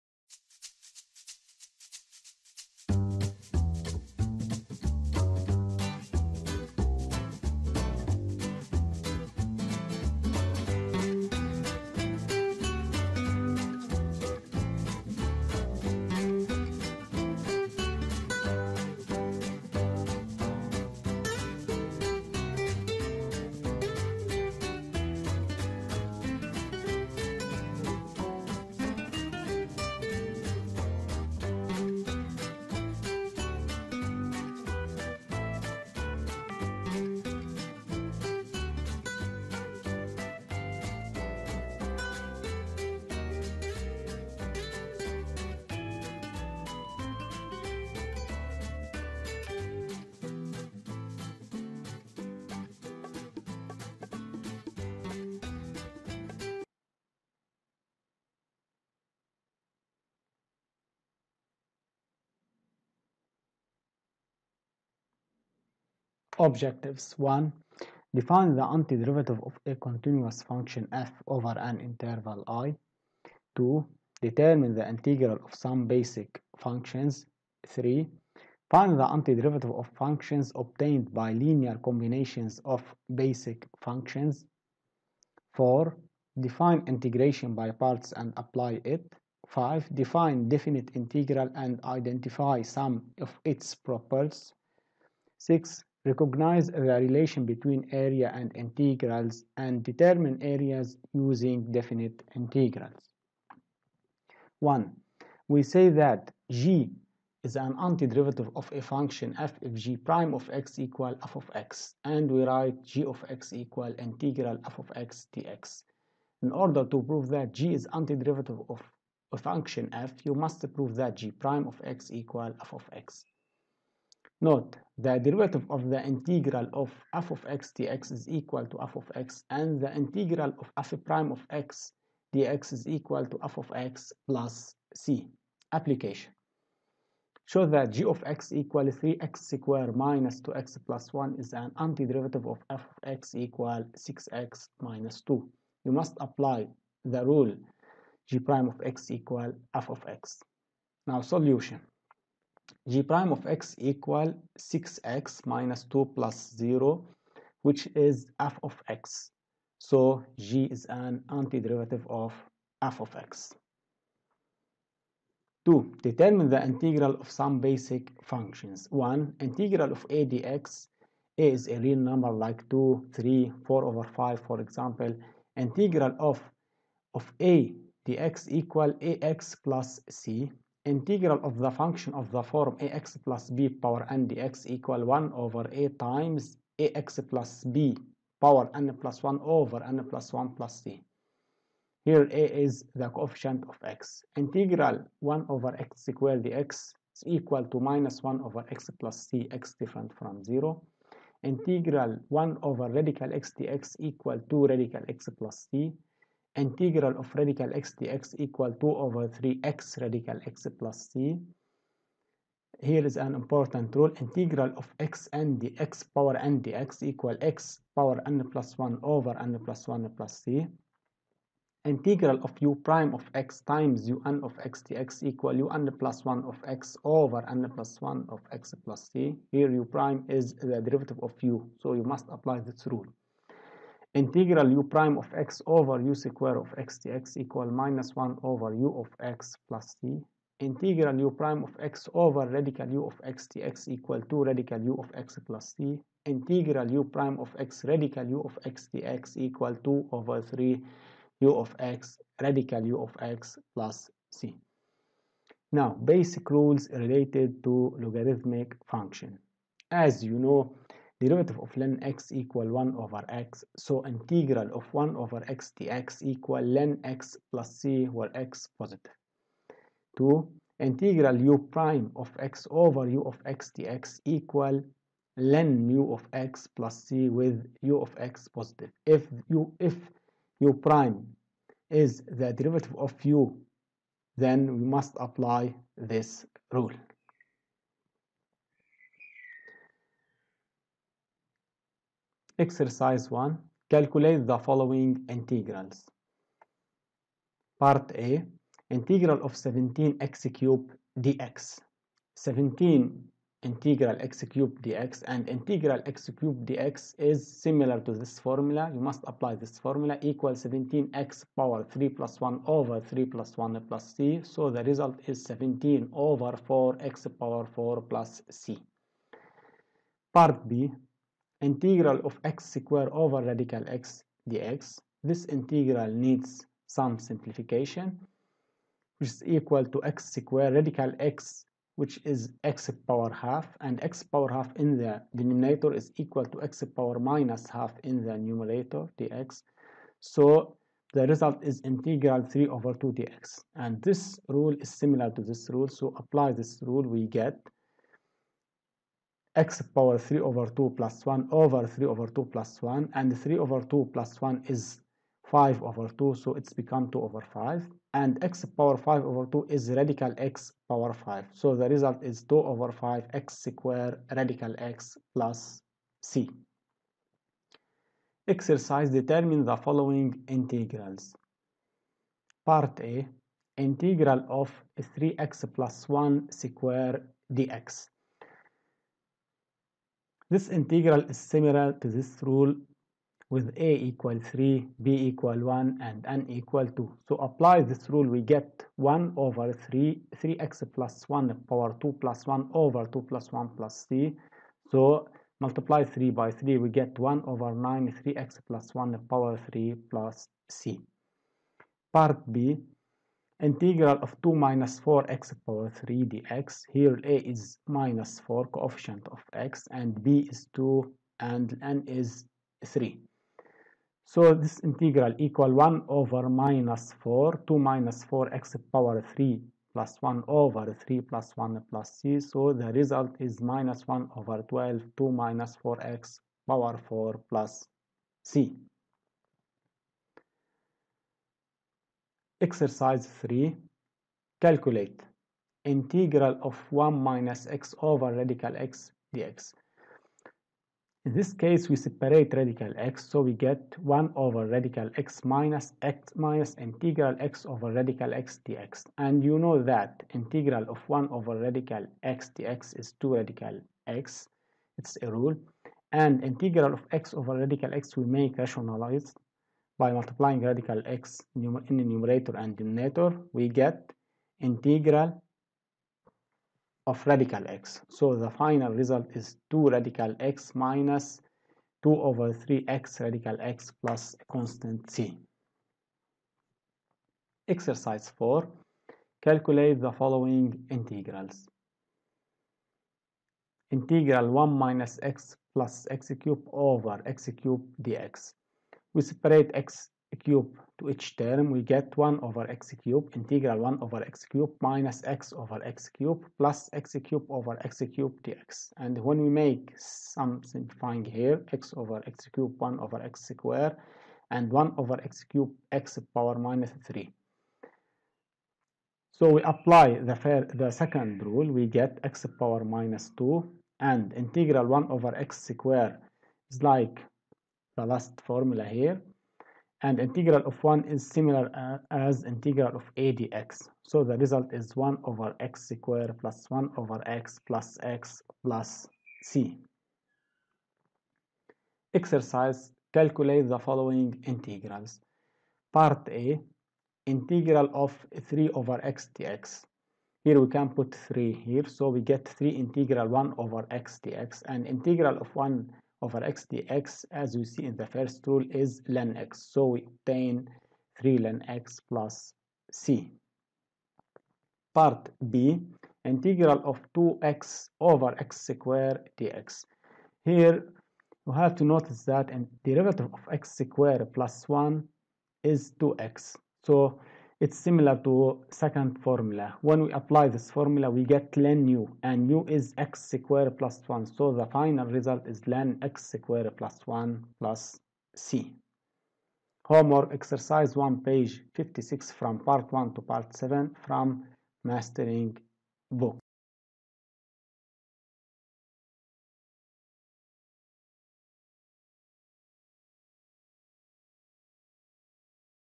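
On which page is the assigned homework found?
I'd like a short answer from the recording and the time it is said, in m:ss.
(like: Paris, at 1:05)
56, at 9:41.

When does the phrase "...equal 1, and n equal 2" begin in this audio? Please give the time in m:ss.
6:25.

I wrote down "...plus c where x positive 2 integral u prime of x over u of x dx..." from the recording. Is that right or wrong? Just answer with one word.
right.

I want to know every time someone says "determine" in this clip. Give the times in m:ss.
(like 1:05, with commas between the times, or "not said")
1:14, 1:39, 2:46, 6:09.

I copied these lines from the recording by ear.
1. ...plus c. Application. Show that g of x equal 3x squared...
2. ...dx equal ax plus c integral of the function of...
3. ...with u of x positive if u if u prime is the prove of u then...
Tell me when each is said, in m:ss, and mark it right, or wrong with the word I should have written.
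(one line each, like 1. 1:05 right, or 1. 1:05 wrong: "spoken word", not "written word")
1. 2:14 right
2. 2:58 right
3. 4:37 wrong: "derivative", not "prove".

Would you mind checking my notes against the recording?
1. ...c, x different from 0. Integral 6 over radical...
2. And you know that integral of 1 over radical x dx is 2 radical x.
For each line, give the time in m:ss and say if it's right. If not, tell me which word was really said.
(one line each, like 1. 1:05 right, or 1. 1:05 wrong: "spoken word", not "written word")
1. 3:19 wrong: "1", not "6"
2. 7:29 right.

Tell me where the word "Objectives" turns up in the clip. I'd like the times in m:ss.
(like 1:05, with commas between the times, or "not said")
1:06.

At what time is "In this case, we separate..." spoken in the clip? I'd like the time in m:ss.
7:21.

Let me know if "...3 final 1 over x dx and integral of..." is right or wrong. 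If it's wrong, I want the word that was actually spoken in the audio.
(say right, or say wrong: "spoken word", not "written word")
wrong: "integral", not "final".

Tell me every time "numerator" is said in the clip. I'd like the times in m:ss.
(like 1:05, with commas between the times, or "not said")
5:38, 7:42.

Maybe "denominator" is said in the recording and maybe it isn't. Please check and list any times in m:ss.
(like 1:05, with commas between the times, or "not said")
5:35, 7:42.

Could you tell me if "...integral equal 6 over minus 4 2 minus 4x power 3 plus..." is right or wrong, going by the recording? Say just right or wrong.
wrong.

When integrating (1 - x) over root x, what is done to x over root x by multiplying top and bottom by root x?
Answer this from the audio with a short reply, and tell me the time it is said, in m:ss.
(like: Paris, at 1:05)
rationalized, at 7:38.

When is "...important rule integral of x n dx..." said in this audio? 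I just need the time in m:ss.
3:33.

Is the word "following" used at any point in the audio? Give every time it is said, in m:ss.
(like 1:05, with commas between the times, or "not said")
4:54, 6:09, 8:00, 8:53.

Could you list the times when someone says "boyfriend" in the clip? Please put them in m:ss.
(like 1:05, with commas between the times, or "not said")
not said.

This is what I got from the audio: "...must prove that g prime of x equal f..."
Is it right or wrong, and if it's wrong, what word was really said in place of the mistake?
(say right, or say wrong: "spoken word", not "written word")
right.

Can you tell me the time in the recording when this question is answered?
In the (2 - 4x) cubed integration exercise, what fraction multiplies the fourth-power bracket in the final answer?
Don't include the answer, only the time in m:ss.
7:03.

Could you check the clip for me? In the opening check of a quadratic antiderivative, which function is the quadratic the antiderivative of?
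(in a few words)
6x - 2.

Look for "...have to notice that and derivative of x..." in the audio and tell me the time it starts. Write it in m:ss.
9:21.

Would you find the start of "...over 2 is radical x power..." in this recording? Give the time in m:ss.
5:59.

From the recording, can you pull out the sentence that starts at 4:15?
Now, basic rules related to logarithmic function.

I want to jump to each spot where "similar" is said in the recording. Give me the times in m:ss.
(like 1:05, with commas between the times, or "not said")
5:07, 5:44, 6:21, 8:41, 9:27.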